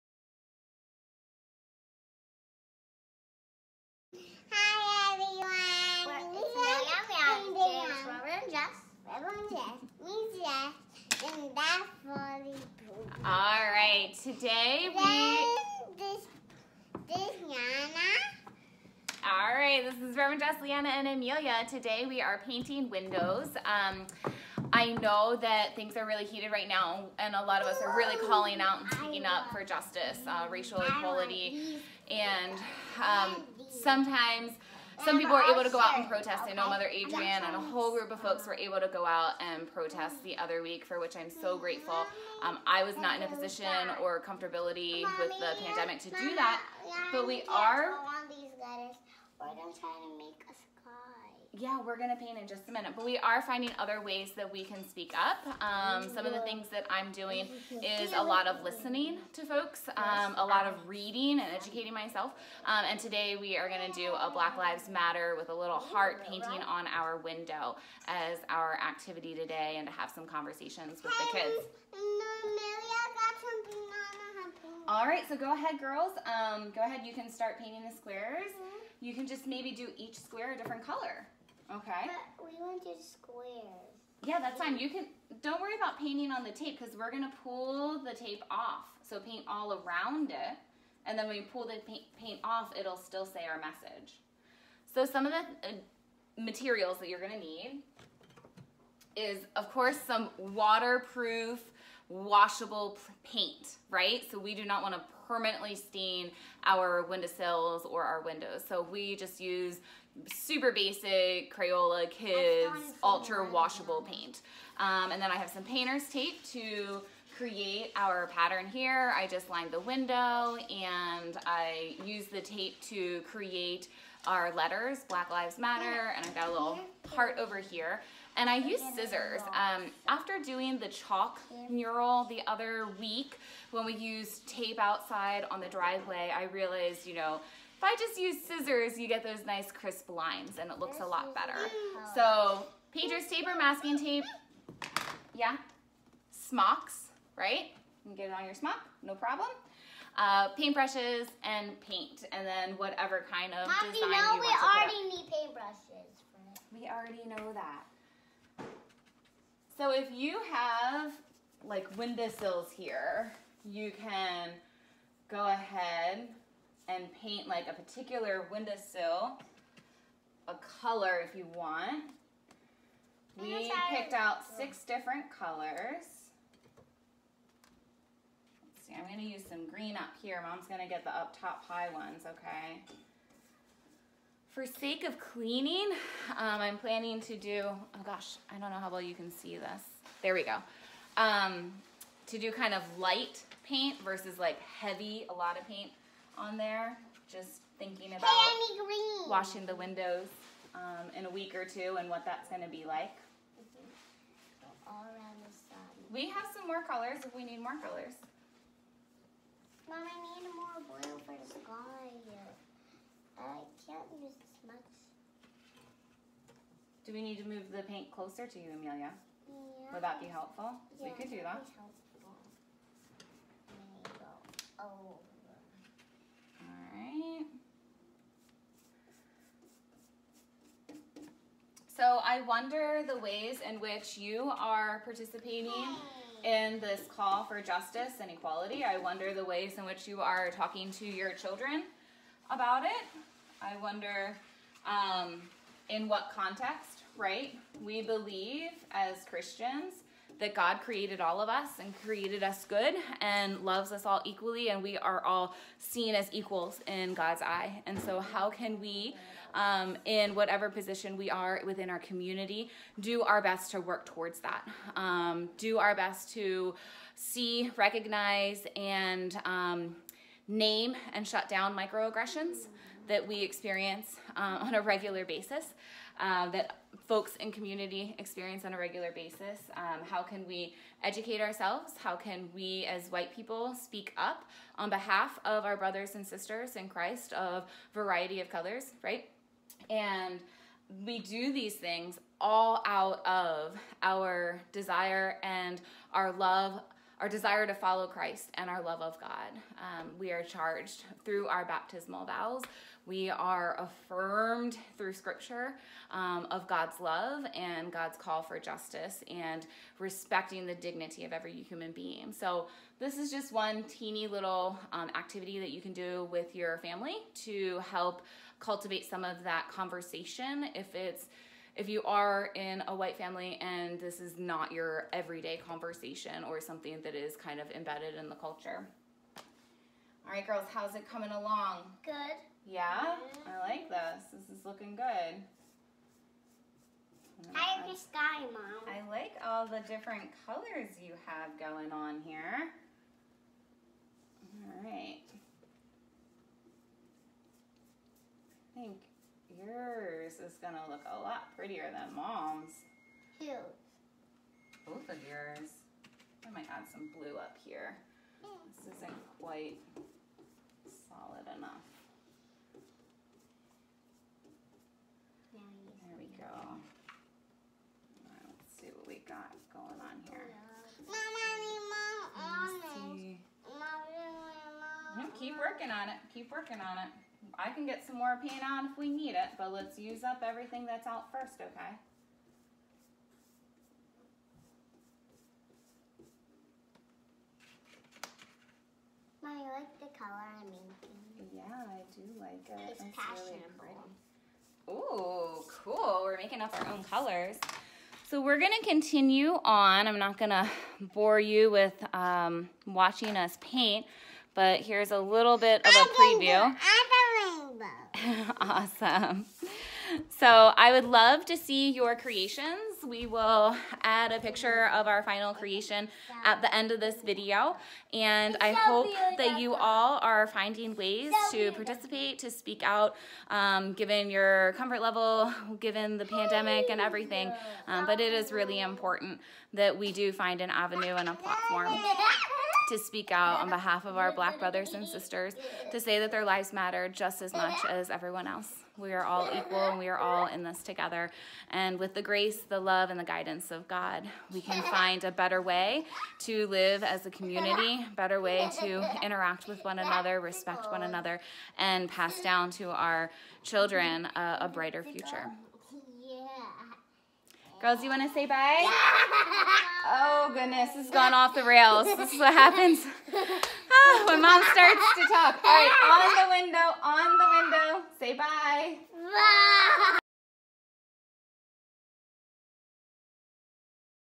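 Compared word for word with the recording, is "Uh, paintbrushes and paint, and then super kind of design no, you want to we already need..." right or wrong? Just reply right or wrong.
wrong.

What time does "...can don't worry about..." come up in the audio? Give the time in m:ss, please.
1:24.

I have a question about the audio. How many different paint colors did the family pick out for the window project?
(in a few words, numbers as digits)
6.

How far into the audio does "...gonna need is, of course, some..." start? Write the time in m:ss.
1:37.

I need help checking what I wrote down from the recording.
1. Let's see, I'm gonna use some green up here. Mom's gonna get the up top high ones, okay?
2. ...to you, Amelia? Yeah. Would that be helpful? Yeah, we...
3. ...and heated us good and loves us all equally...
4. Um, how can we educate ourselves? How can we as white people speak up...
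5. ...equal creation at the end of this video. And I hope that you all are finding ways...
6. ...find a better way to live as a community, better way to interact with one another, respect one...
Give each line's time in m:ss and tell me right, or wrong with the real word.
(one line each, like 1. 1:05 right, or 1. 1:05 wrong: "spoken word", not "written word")
1. 2:58 right
2. 3:38 right
3. 4:11 wrong: "created", not "heated"
4. 4:39 right
5. 6:55 wrong: "final", not "equal"
6. 7:24 right.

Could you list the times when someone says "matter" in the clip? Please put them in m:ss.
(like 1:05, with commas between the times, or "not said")
1:04, 2:05, 7:16.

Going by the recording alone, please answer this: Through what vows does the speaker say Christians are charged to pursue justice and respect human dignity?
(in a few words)
baptismal vows.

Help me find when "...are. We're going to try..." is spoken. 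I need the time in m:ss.
0:47.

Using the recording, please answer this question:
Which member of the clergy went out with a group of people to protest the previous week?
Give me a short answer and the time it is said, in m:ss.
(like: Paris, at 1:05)
Mother Adrian, at 0:36.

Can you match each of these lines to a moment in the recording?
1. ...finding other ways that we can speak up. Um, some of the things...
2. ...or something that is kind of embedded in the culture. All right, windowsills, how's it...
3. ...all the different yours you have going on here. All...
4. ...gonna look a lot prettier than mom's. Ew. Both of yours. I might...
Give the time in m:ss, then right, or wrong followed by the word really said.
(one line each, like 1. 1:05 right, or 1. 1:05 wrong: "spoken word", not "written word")
1. 0:53 right
2. 5:26 wrong: "girls", not "windowsills"
3. 5:39 wrong: "colors", not "yours"
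4. 5:50 right.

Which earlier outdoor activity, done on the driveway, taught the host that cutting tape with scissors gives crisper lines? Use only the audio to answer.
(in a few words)
chalk mural.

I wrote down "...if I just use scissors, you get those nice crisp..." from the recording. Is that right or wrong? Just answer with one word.
right.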